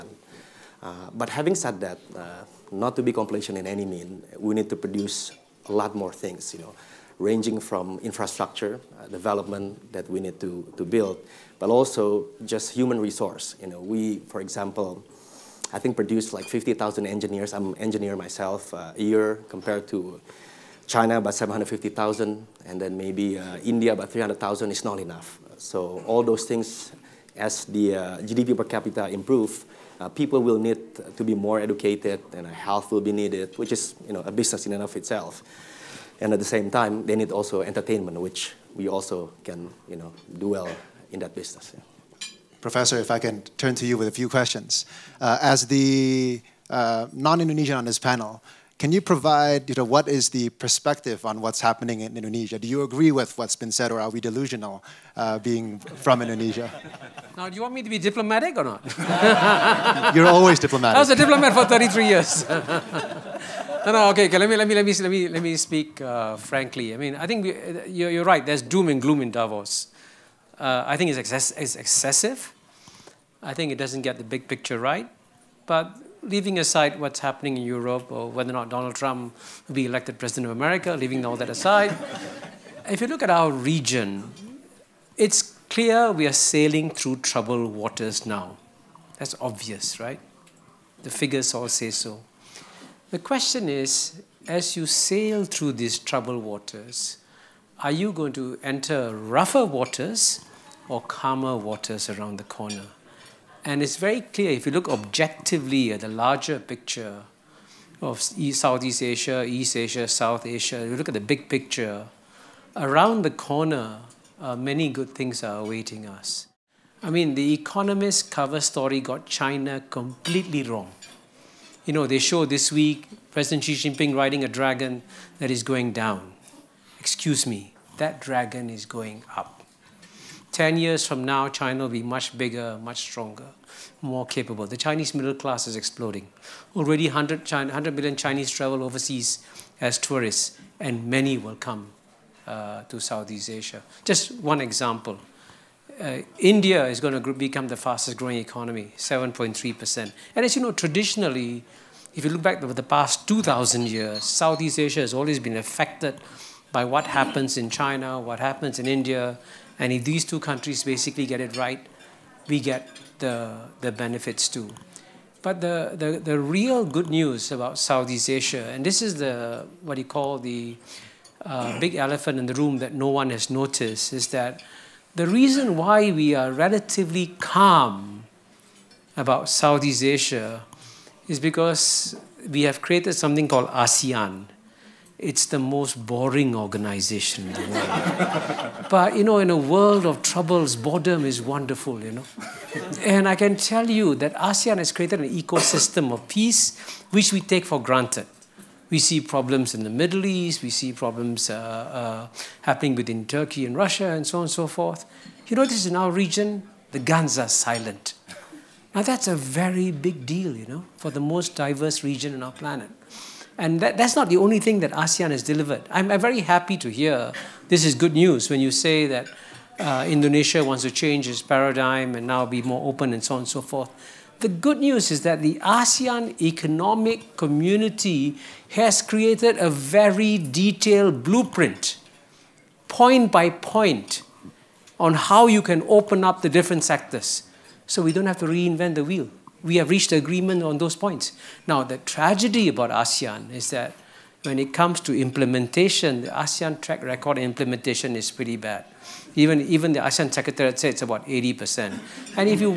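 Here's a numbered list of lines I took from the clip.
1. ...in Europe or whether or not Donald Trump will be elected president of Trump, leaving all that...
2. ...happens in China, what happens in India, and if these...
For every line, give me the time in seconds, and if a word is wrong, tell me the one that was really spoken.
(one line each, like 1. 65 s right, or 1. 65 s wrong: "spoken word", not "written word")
1. 77 s wrong: "America", not "Trump"
2. 157 s right.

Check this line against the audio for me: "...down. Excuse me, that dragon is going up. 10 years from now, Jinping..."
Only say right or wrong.
wrong.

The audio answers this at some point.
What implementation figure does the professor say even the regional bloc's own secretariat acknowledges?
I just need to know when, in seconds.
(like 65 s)
251 s.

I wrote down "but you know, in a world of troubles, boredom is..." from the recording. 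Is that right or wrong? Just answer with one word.
right.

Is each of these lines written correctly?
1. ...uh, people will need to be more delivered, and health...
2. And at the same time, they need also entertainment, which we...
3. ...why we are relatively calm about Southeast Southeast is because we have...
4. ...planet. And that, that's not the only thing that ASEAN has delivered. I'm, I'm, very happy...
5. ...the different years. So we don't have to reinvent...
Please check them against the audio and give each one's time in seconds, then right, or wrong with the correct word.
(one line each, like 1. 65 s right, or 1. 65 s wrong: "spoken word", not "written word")
1. 30 s wrong: "educated", not "delivered"
2. 36 s right
3. 175 s wrong: "Asia", not "Southeast"
4. 212 s right
5. 236 s wrong: "sectors", not "years".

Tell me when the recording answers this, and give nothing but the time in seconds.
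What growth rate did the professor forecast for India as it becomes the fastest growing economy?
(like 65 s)
148 s.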